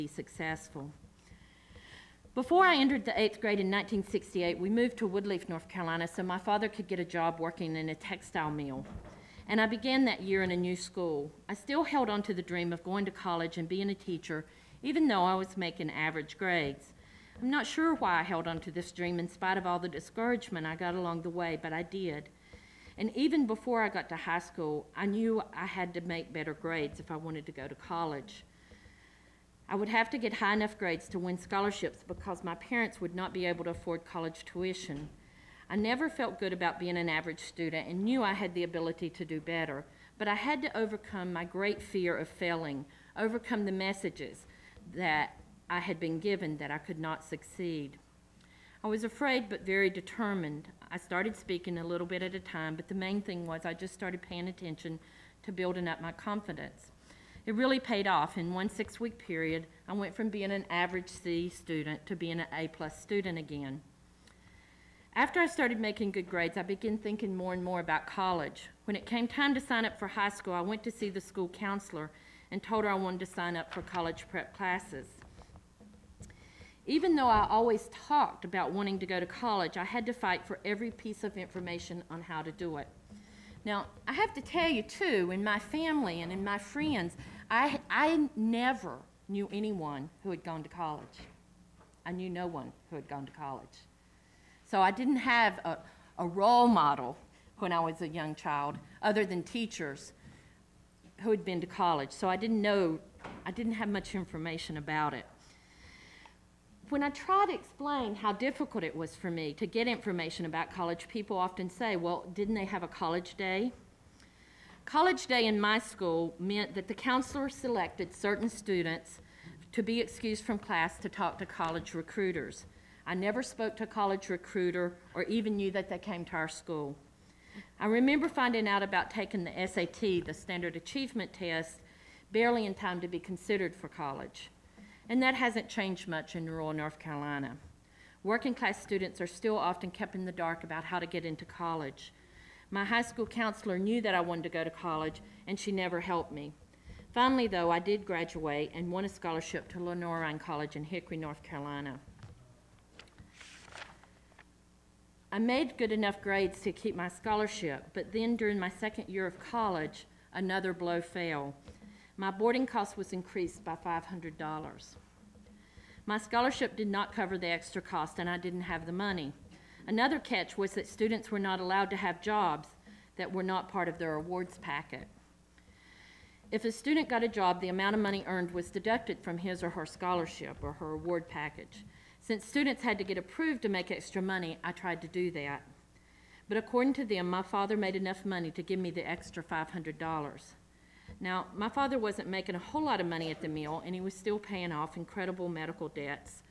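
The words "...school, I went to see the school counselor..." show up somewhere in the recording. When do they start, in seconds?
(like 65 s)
70 s.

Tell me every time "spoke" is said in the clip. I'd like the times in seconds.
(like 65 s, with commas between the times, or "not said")
123 s.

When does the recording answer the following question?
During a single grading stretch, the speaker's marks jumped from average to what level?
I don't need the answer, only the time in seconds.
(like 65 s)
62 s.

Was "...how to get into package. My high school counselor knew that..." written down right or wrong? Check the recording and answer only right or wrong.
wrong.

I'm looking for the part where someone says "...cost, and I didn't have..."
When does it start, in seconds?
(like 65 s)
167 s.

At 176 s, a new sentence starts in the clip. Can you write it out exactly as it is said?
If a student got a job, the amount of money earned was deducted from his or her scholarship or her award package.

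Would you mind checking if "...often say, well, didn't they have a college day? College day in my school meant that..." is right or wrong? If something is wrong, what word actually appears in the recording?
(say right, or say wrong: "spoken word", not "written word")
right.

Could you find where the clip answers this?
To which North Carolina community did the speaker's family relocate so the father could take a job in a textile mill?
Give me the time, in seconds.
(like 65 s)
5 s.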